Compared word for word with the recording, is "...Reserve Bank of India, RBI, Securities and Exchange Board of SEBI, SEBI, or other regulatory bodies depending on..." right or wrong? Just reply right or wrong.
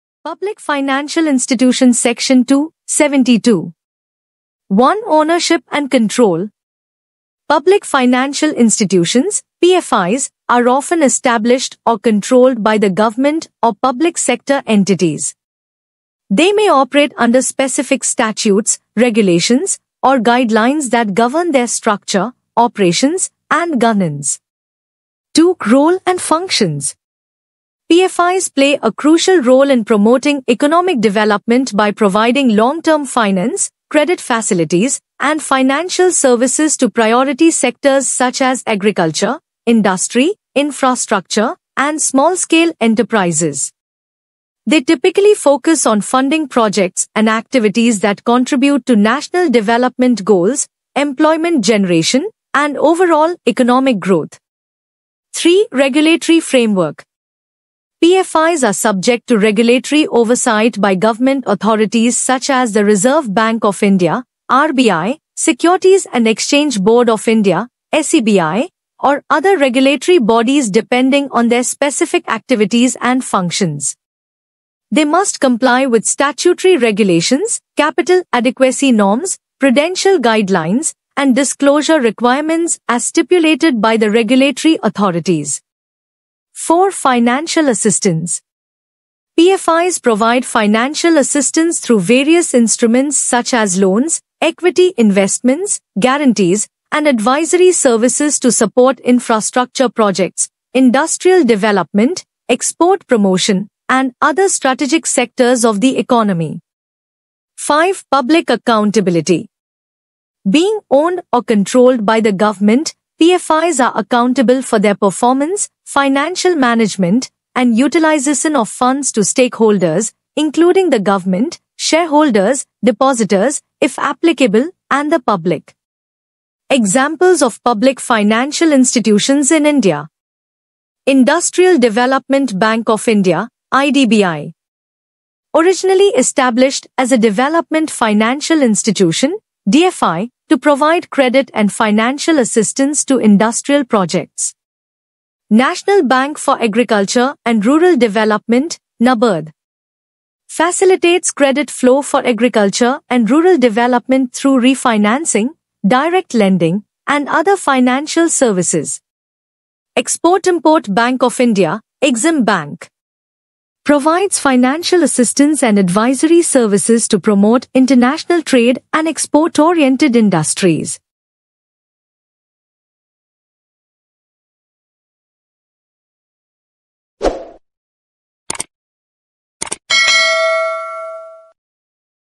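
wrong.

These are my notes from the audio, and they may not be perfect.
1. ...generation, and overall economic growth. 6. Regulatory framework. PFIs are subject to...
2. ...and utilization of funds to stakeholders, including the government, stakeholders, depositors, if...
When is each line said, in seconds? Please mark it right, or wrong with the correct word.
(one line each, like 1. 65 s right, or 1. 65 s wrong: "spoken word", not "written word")
1. 51 s wrong: "3", not "6"
2. 117 s wrong: "shareholders", not "stakeholders".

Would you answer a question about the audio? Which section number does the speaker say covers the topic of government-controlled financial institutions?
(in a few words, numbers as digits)
Section 272.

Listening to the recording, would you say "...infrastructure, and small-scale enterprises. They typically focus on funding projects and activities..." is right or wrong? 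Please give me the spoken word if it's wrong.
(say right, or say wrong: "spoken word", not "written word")
right.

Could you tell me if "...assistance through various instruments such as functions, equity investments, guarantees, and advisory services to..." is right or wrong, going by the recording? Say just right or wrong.
wrong.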